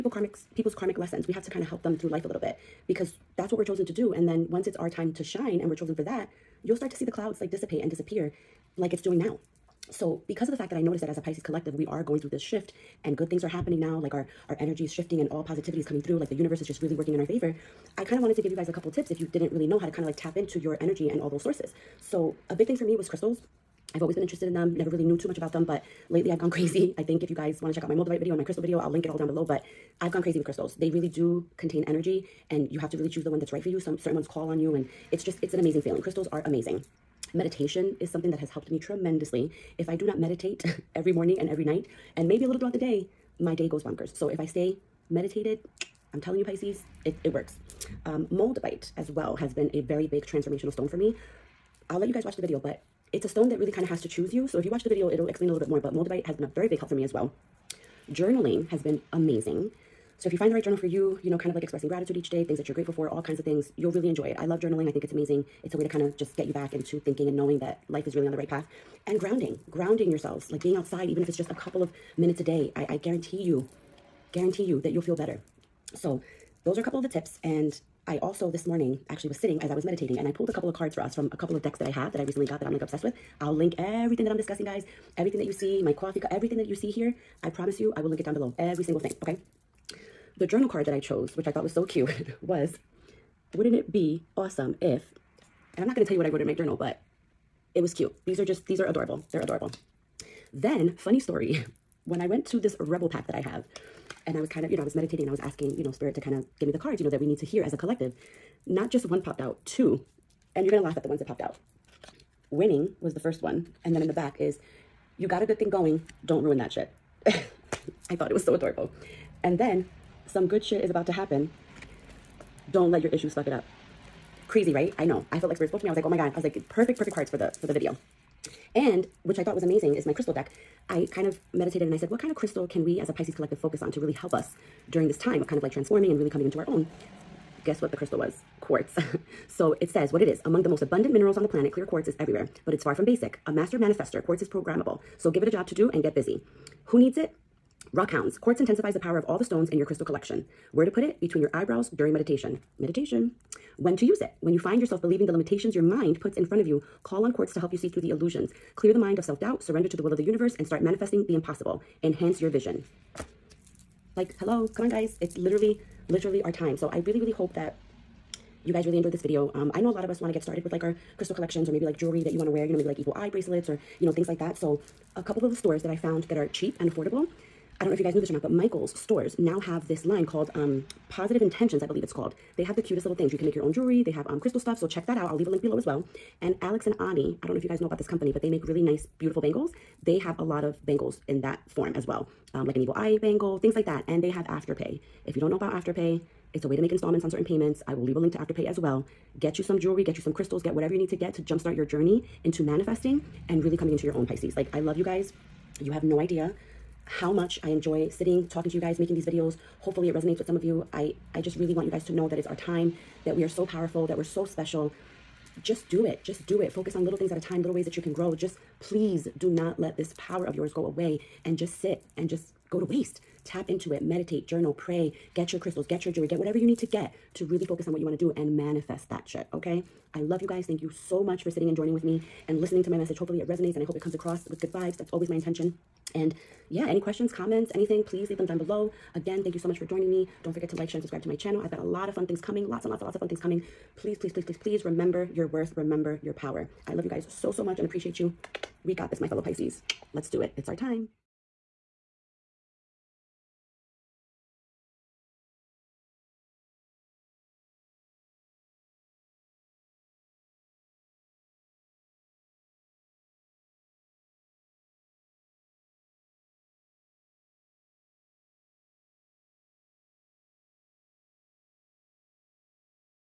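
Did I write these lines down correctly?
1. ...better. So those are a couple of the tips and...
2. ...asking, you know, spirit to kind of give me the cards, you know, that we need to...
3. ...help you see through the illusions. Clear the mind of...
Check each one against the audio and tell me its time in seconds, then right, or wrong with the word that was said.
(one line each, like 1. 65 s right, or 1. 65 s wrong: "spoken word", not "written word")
1. 75 s right
2. 105 s right
3. 157 s right.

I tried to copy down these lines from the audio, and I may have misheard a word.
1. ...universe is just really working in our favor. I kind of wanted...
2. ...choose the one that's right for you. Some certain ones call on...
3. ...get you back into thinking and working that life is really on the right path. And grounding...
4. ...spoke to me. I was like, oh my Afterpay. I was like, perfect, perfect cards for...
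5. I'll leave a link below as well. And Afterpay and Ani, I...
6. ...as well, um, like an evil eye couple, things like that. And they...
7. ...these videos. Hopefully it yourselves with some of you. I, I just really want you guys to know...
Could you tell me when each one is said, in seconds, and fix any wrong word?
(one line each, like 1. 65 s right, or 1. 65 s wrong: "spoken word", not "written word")
1. 16 s right
2. 33 s right
3. 66 s wrong: "knowing", not "working"
4. 125 s wrong: "God", not "Afterpay"
5. 185 s wrong: "Alex", not "Afterpay"
6. 191 s wrong: "bangle", not "couple"
7. 209 s wrong: "resonates", not "yourselves".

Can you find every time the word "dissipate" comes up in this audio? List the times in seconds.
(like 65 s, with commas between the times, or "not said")
7 s.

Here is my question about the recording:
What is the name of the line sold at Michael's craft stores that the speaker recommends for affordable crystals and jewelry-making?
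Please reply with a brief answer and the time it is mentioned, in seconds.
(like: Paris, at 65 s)
Positive Intentions, at 181 s.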